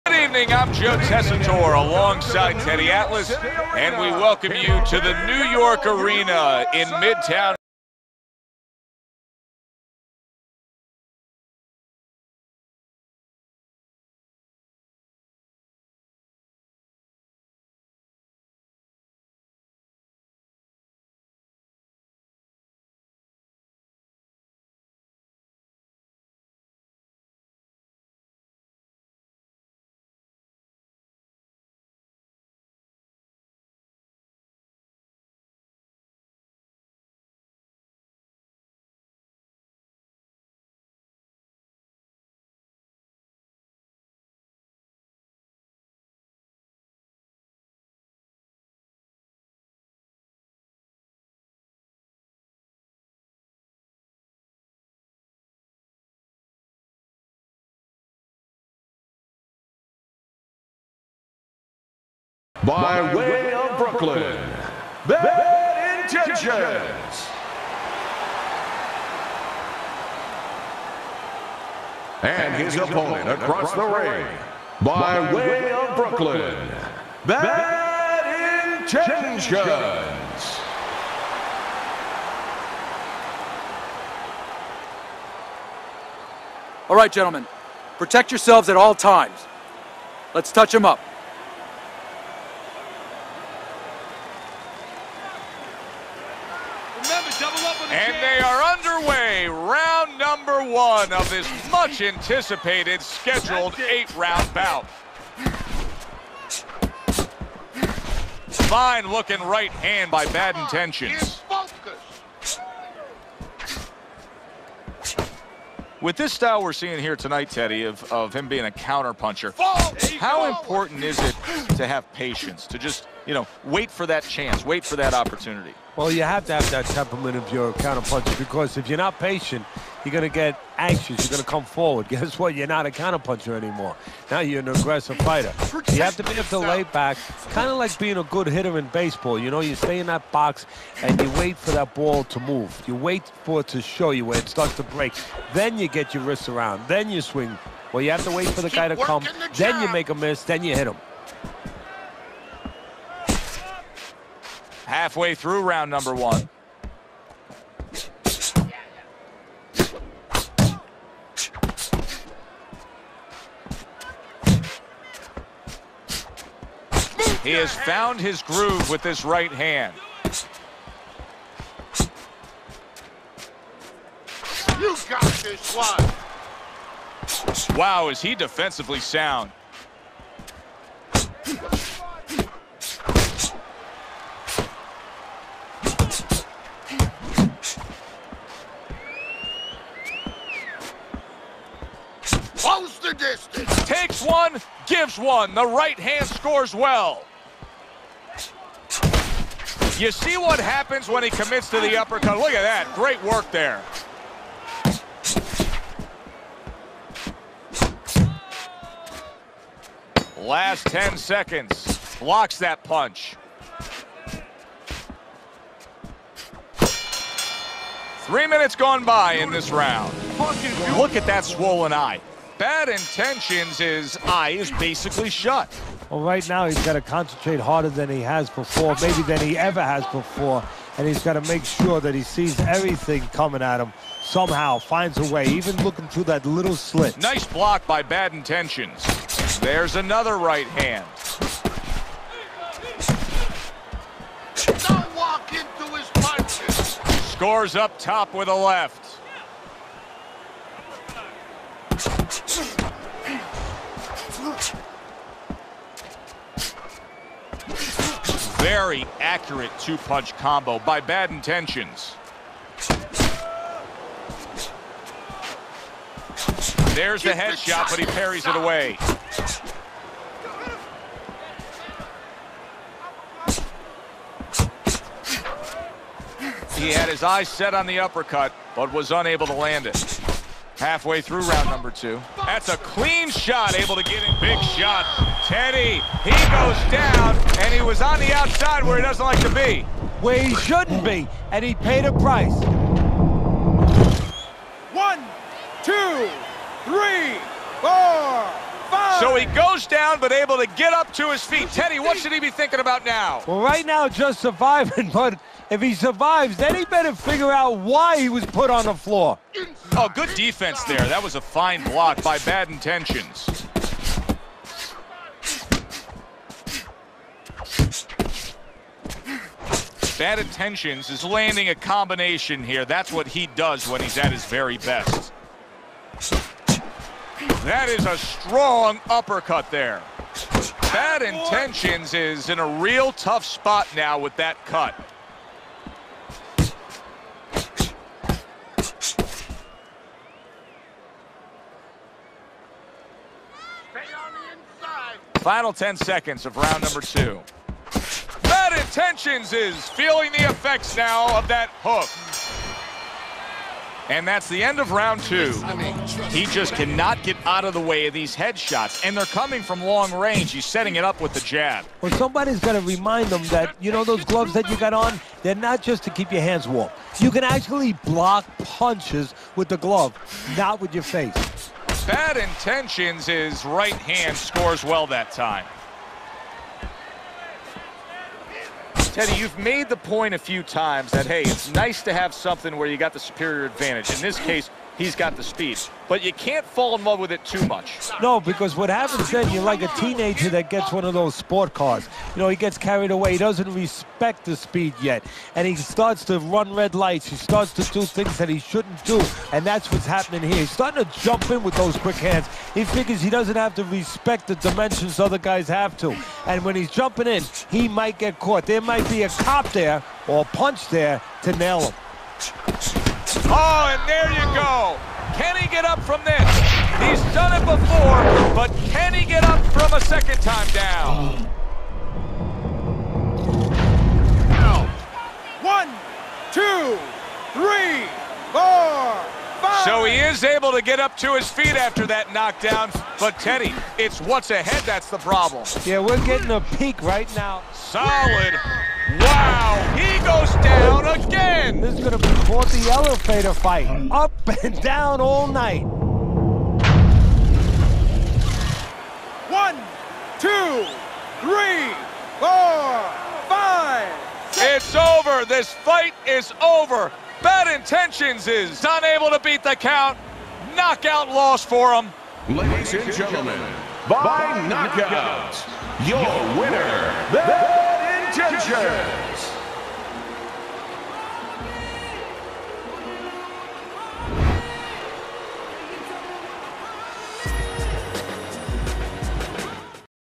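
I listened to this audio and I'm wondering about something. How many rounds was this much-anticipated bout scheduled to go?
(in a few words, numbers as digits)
8.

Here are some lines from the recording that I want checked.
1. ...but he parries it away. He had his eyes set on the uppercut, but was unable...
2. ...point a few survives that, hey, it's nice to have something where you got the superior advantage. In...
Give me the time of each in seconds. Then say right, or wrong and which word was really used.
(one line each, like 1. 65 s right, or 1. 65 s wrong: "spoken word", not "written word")
1. 267 s right
2. 379 s wrong: "times", not "survives".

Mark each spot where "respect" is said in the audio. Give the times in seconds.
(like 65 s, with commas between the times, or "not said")
393 s, 403 s.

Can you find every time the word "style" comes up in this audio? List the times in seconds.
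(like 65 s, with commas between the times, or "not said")
116 s.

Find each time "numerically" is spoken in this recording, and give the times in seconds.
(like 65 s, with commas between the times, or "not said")
not said.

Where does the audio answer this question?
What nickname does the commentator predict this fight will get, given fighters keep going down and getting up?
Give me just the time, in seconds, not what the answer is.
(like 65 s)
442 s.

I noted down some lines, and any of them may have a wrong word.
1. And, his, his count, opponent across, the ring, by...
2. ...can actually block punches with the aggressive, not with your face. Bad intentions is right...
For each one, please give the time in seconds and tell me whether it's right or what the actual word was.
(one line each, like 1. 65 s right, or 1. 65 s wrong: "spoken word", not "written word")
1. 72 s wrong: "opponent", not "count"
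2. 367 s wrong: "glove", not "aggressive".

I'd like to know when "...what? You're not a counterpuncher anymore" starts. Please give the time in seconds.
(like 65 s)
132 s.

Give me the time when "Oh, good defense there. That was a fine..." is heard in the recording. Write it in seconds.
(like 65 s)
309 s.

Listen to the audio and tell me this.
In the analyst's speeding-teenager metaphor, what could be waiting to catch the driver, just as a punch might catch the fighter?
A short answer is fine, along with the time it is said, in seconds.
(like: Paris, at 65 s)
A cop, at 409 s.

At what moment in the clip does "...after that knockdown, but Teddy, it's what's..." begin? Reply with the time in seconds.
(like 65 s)
431 s.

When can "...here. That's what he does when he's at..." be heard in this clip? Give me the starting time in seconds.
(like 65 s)
322 s.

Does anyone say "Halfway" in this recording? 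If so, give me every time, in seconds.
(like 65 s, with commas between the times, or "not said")
154 s, 280 s.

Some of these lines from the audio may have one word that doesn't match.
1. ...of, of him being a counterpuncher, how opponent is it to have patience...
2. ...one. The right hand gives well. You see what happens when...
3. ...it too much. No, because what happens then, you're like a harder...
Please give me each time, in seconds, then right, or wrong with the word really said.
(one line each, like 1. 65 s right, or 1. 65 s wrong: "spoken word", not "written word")
1. 117 s wrong: "important", not "opponent"
2. 195 s wrong: "scores", not "gives"
3. 387 s wrong: "teenager", not "harder".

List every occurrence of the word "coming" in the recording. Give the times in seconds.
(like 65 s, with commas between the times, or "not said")
233 s, 359 s.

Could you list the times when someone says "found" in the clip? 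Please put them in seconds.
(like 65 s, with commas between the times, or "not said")
167 s.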